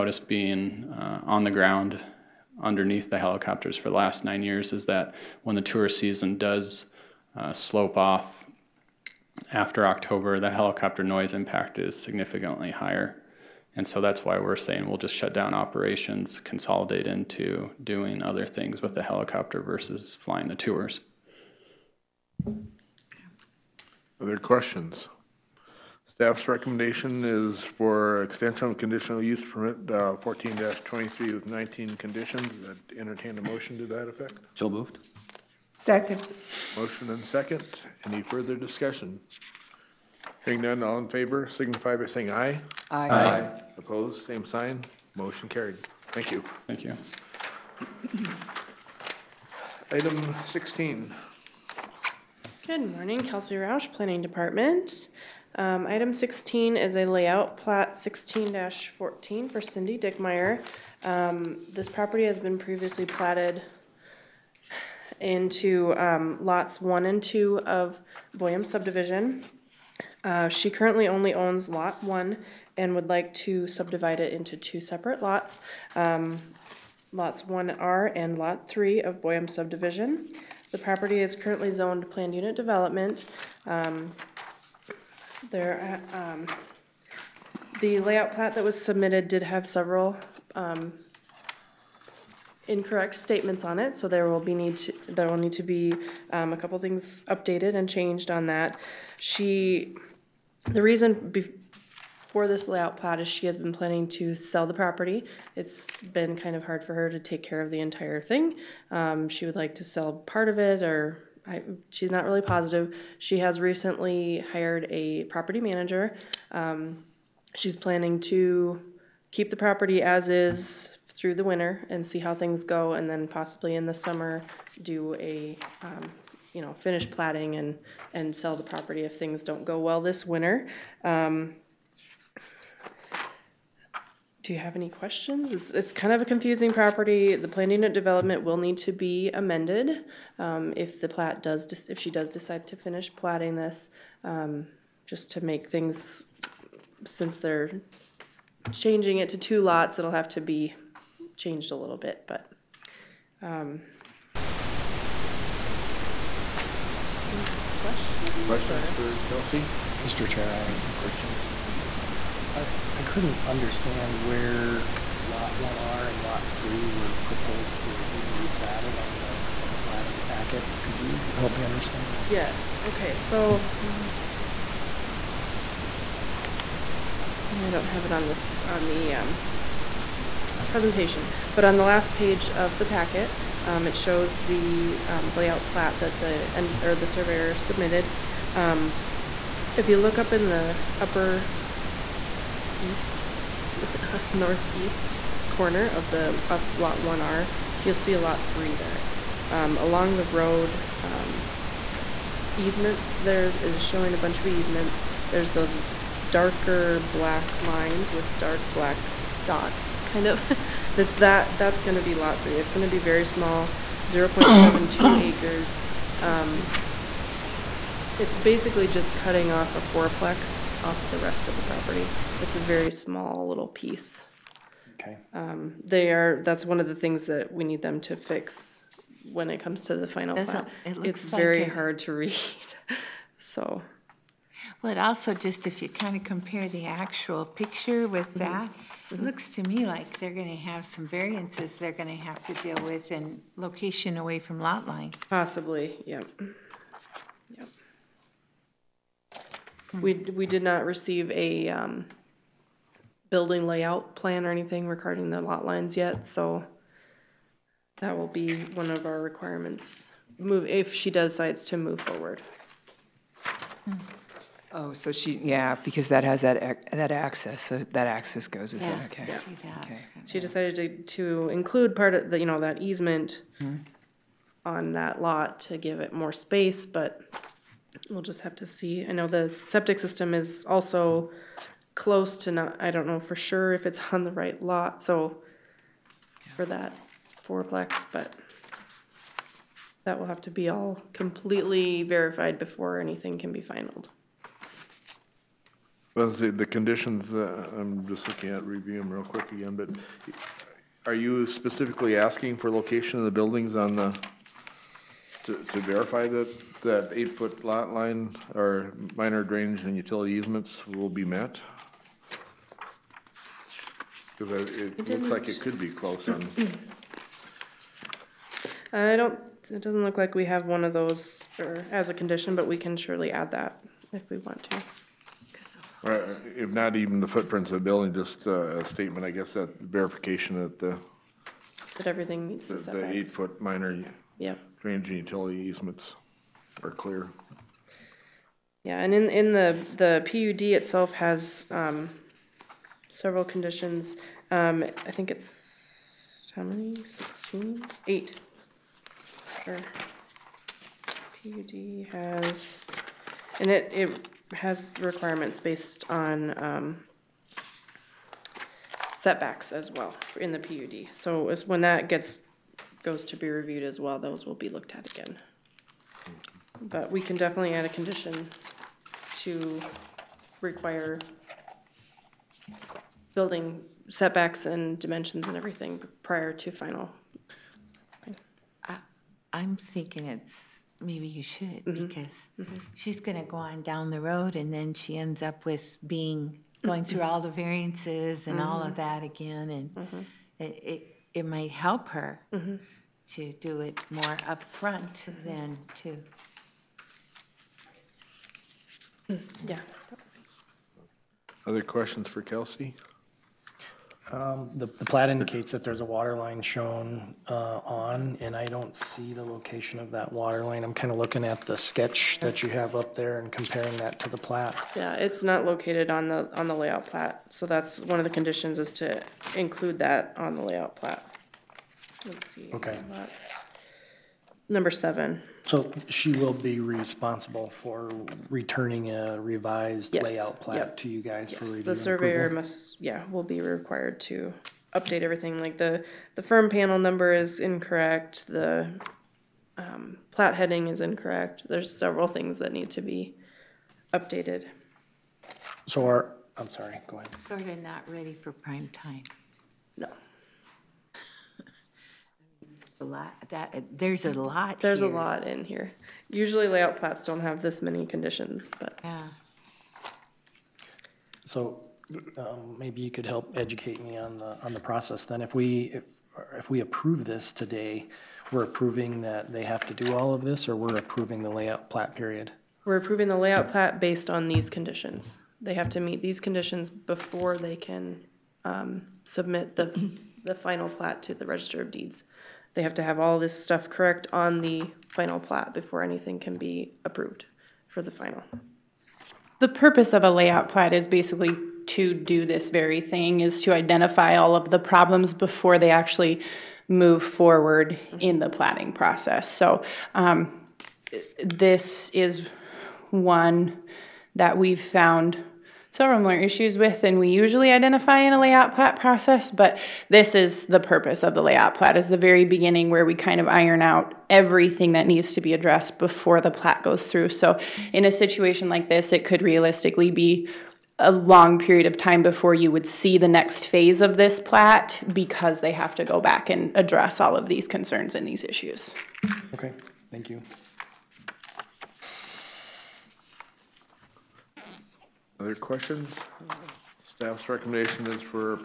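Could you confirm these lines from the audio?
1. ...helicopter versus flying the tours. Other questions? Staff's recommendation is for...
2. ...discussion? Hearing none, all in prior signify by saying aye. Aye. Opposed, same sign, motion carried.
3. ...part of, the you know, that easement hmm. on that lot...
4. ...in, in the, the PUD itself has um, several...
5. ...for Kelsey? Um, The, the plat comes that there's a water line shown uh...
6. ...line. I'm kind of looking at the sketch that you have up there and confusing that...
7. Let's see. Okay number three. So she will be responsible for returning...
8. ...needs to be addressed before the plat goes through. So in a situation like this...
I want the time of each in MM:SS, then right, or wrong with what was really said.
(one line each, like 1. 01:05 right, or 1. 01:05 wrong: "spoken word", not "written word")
1. 00:19 right
2. 00:38 wrong: "favor", not "prior"
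3. 04:31 right
4. 05:39 right
5. 06:42 wrong: "indicates", not "comes"
6. 06:50 wrong: "comparing", not "confusing"
7. 07:02 wrong: "seven", not "three"
8. 08:35 right.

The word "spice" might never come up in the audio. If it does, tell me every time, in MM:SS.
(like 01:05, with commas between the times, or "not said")
not said.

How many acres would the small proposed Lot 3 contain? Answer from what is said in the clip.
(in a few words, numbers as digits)
0.72.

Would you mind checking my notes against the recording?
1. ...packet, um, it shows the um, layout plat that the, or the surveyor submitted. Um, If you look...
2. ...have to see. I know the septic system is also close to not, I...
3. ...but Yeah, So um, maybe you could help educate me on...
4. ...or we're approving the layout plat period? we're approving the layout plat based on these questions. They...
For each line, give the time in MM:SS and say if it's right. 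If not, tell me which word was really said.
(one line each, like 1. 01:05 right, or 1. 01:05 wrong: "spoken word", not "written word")
1. 03:02 right
2. 04:38 right
3. 07:38 right
4. 07:50 wrong: "conditions", not "questions".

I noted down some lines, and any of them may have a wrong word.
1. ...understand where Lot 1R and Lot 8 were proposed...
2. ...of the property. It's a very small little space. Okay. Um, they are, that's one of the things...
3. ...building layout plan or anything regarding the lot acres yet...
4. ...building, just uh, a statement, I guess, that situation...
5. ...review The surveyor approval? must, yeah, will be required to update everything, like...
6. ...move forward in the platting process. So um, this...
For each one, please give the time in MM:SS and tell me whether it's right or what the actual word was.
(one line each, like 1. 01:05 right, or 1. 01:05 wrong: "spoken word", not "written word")
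1. 02:43 wrong: "3", not "8"
2. 03:41 wrong: "piece", not "space"
3. 04:13 wrong: "lines", not "acres"
4. 05:27 wrong: "verification", not "situation"
5. 07:11 right
6. 08:16 right.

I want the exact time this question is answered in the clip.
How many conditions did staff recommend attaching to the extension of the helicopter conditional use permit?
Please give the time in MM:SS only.
00:31.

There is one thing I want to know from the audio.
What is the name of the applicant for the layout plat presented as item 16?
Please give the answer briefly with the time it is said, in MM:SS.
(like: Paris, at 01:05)
Cindy Dickmeyer, at 00:59.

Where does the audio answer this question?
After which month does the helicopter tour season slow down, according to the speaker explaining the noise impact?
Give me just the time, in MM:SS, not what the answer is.
00:09.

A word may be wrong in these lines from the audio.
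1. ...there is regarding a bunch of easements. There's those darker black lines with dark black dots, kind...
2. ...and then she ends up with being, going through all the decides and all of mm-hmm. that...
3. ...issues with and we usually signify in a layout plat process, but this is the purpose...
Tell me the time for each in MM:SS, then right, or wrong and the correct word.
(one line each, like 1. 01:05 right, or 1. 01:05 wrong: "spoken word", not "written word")
1. 03:23 wrong: "showing", not "regarding"
2. 06:24 wrong: "variances", not "decides"
3. 08:26 wrong: "identify", not "signify".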